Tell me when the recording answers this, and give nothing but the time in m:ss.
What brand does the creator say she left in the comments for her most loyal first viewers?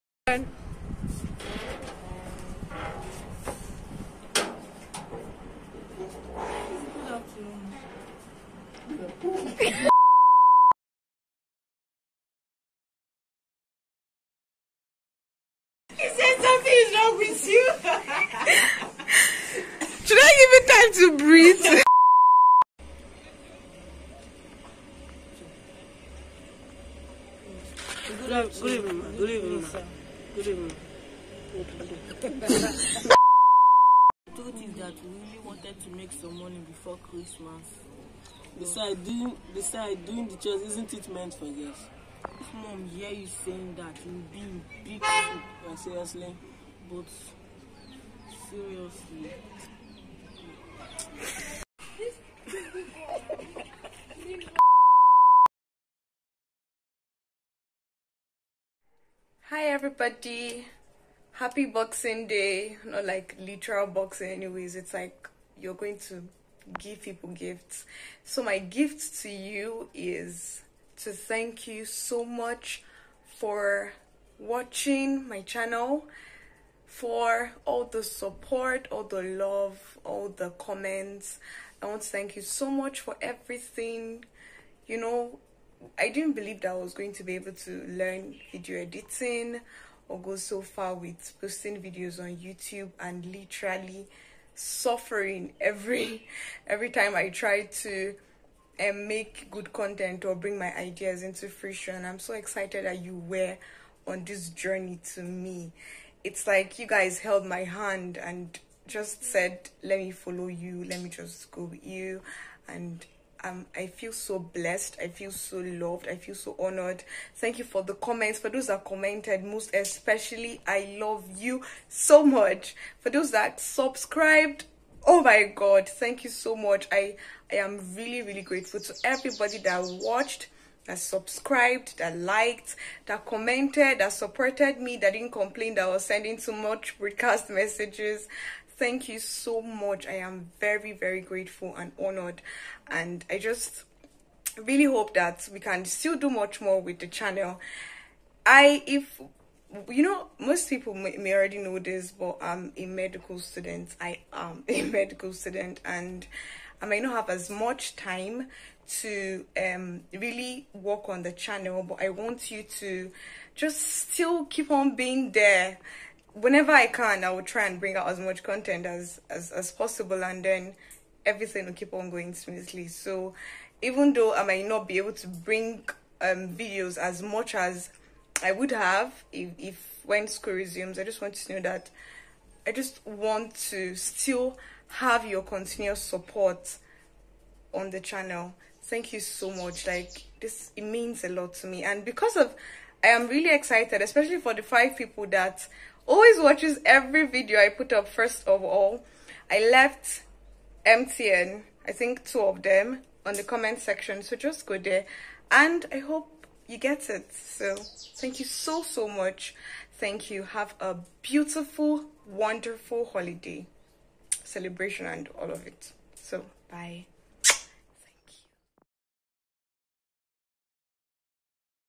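3:20.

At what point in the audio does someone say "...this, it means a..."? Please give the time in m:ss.
3:10.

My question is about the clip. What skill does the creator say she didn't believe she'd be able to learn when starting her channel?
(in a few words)
video editing.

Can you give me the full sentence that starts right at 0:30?
told you that we really wanted to make some money before Christmas.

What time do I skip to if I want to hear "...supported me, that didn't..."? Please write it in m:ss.
2:14.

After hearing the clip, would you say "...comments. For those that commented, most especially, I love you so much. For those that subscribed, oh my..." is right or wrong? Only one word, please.
right.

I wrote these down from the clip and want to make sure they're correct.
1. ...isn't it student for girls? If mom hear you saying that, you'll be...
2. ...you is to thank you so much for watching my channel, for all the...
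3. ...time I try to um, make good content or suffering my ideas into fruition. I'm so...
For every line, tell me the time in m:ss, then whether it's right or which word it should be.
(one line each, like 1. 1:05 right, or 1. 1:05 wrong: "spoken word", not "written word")
1. 0:40 wrong: "meant", not "student"
2. 1:09 right
3. 1:36 wrong: "bring", not "suffering".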